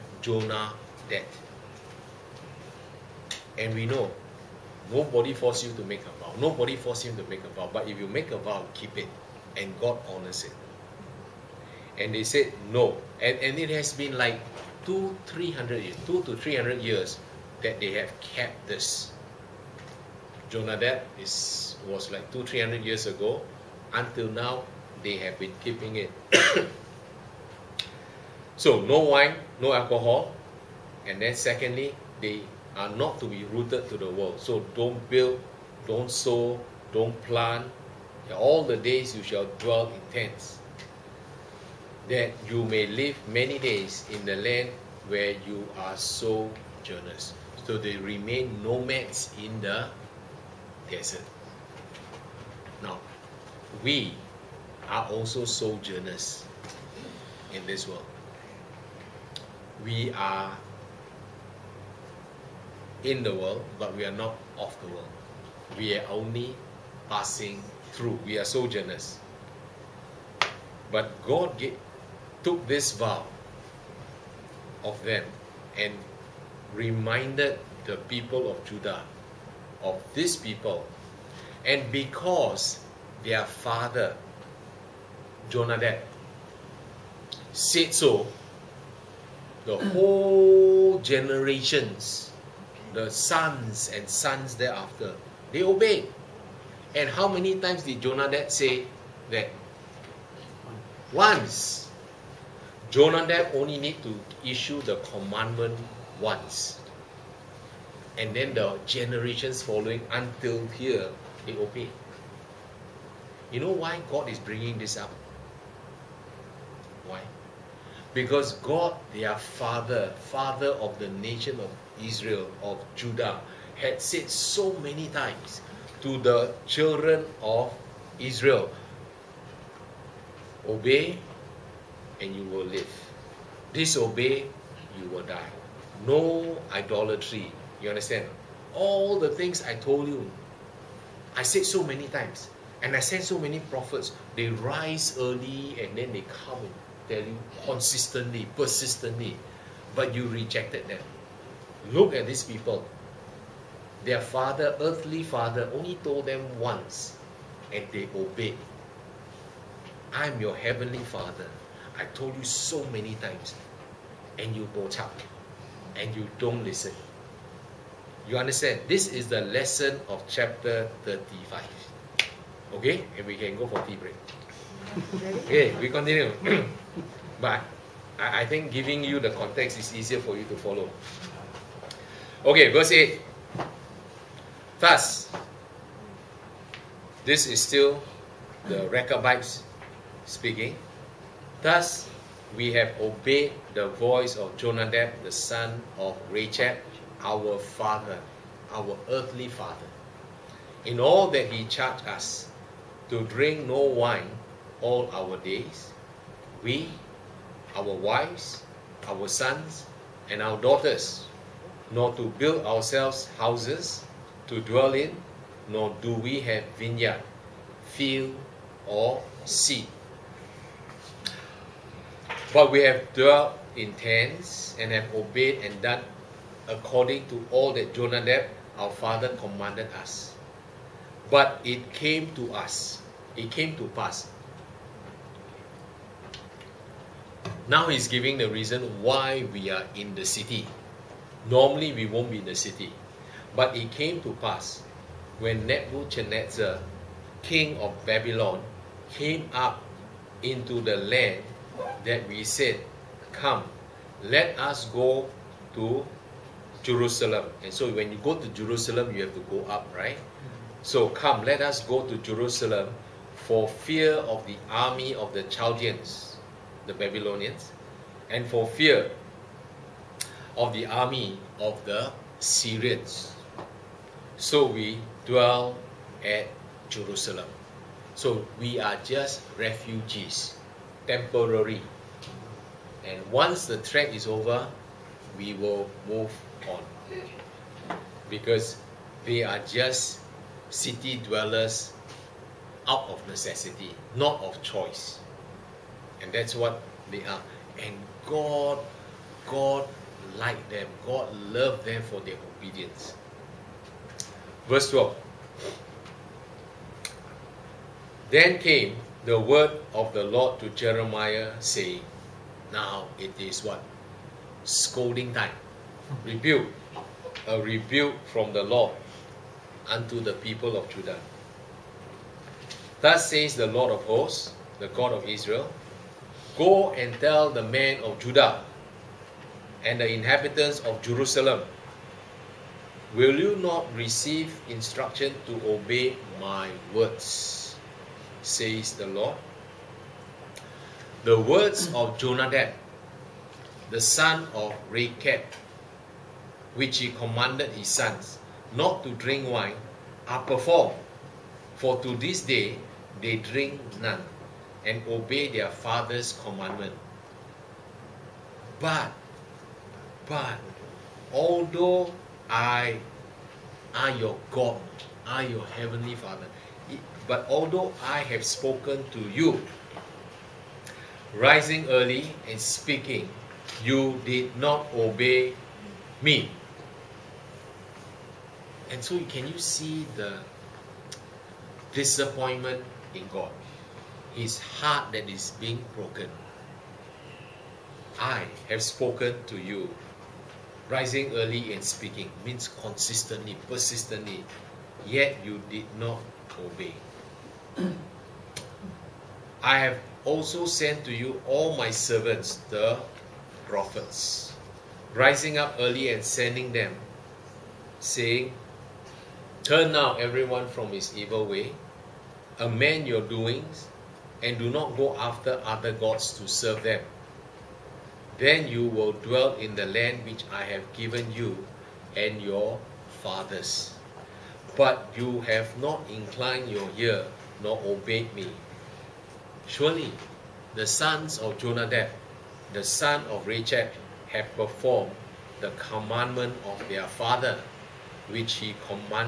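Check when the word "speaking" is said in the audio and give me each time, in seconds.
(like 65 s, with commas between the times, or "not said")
190 s, 372 s, 391 s.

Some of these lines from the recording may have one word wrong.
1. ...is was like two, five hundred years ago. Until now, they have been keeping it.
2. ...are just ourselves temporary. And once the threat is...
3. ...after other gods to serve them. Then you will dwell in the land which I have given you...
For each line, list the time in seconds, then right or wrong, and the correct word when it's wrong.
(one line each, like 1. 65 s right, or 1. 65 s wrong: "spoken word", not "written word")
1. 21 s wrong: "three", not "five"
2. 278 s wrong: "refugees", not "ourselves"
3. 415 s right.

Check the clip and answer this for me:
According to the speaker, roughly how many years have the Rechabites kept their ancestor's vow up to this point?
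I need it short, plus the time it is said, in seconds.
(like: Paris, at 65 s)
200 to 300 years, at 16 s.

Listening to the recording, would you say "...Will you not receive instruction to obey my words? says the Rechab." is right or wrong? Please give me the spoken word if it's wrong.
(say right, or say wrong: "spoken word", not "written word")
wrong: "Lord", not "Rechab".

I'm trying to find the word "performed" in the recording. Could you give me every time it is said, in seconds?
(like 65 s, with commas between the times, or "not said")
350 s, 434 s.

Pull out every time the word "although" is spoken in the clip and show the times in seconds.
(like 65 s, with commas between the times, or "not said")
361 s, 367 s.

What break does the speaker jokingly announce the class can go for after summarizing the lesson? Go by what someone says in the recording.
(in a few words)
tea break.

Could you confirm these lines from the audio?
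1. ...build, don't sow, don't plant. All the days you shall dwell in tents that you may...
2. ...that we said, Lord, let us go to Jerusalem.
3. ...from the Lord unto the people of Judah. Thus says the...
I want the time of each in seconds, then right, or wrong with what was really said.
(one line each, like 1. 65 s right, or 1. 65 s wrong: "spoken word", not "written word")
1. 35 s right
2. 252 s wrong: "Come", not "Lord"
3. 318 s right.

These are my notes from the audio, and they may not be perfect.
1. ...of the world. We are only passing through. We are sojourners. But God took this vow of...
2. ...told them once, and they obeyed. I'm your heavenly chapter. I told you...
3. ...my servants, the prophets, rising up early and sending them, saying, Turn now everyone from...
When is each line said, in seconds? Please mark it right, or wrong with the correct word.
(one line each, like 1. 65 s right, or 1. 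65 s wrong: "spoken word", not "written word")
1. 64 s right
2. 156 s wrong: "father", not "chapter"
3. 401 s right.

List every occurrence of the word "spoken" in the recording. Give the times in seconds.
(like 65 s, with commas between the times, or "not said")
368 s, 388 s.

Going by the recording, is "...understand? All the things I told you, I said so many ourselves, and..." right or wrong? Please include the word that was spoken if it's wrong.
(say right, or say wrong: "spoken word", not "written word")
wrong: "times", not "ourselves".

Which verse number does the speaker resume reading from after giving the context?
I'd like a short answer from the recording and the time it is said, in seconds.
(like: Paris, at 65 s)
8, at 182 s.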